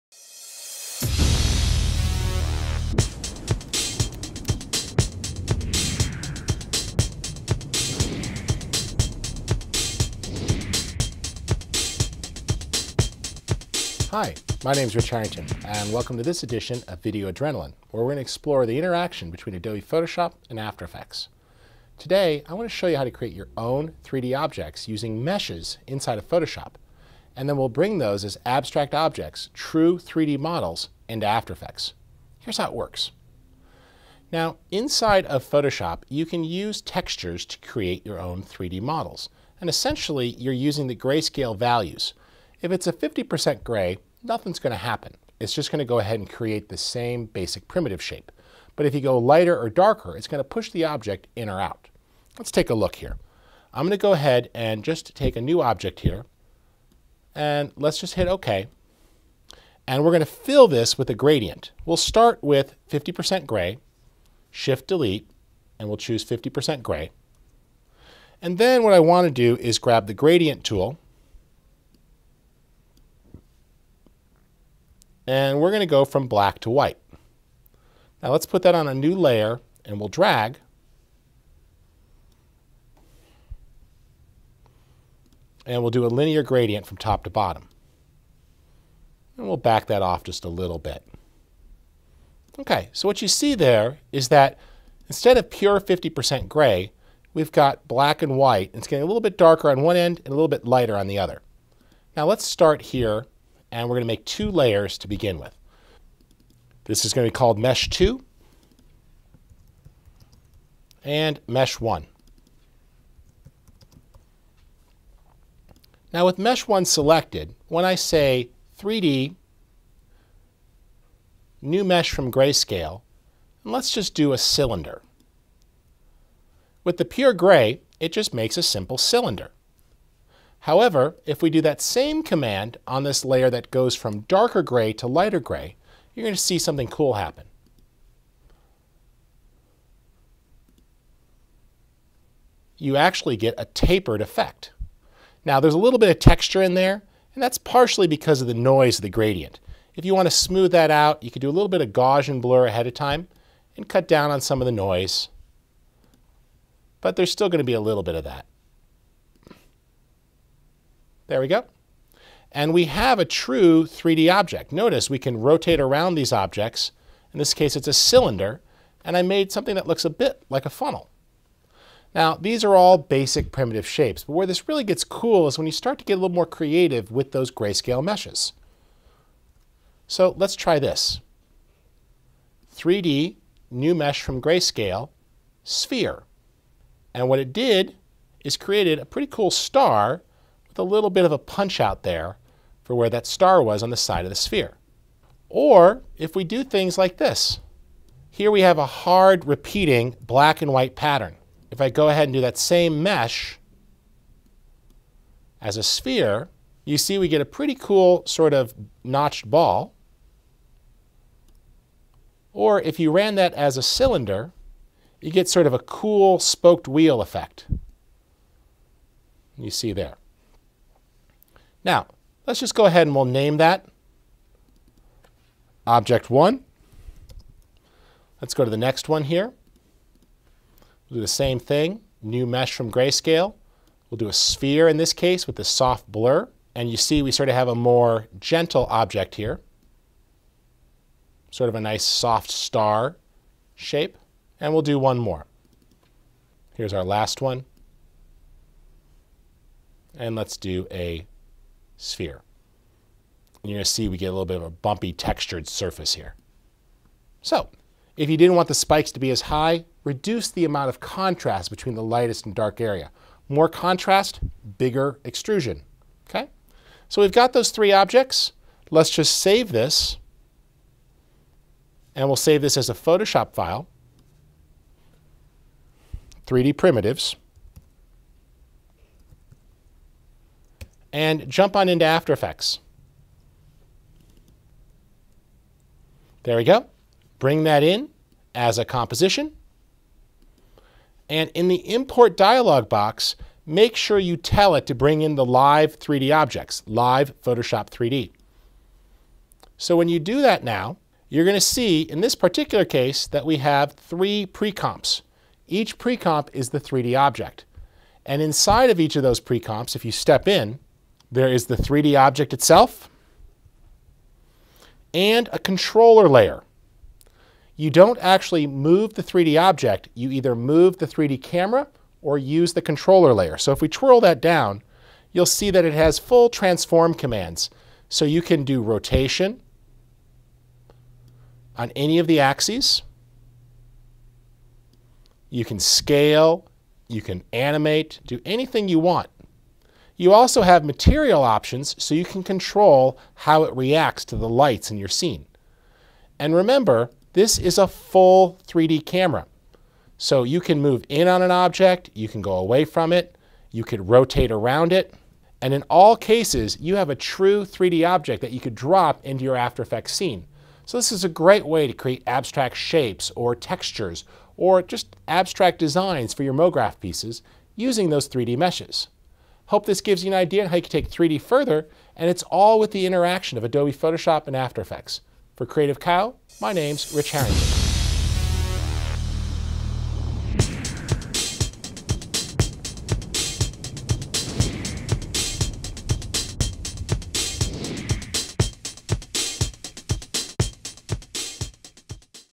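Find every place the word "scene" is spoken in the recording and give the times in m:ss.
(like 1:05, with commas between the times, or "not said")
5:45, 6:00.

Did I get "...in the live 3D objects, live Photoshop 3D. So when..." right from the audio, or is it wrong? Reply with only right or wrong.
right.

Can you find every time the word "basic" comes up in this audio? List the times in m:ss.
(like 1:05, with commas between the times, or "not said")
0:47, 2:52.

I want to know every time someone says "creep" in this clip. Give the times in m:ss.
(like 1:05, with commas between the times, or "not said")
not said.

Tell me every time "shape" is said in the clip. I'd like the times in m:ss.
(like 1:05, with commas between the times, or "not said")
0:48, 2:53, 4:03, 6:02.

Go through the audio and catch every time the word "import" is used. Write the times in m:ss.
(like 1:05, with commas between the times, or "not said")
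4:51.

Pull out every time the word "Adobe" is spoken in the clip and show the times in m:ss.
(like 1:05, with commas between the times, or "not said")
0:19, 6:13.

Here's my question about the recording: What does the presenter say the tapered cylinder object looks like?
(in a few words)
a funnel.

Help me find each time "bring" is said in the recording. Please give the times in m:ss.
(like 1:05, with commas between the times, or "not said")
0:27, 4:47, 4:54.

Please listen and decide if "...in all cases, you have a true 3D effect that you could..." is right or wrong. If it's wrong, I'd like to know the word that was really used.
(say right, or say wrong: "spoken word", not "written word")
wrong: "object", not "effect".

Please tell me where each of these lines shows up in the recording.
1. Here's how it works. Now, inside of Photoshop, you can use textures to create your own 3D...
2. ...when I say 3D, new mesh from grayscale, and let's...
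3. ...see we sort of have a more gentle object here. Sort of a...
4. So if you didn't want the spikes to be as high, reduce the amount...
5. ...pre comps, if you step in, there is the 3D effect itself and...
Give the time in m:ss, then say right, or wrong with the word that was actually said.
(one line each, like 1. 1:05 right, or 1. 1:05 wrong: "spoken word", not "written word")
1. 0:32 right
2. 1:57 right
3. 3:56 right
4. 4:17 right
5. 5:09 wrong: "object", not "effect".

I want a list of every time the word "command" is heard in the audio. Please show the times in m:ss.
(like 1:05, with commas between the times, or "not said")
2:12, 5:27.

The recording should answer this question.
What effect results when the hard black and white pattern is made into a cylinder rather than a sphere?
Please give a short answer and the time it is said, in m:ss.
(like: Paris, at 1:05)
spoked wheel, at 3:36.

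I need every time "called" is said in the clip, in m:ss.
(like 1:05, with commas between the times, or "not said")
1:47.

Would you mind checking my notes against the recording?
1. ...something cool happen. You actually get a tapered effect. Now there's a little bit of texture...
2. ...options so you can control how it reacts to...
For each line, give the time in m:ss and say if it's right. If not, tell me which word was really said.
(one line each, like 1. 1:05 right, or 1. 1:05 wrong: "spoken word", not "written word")
1. 2:16 right
2. 5:41 right.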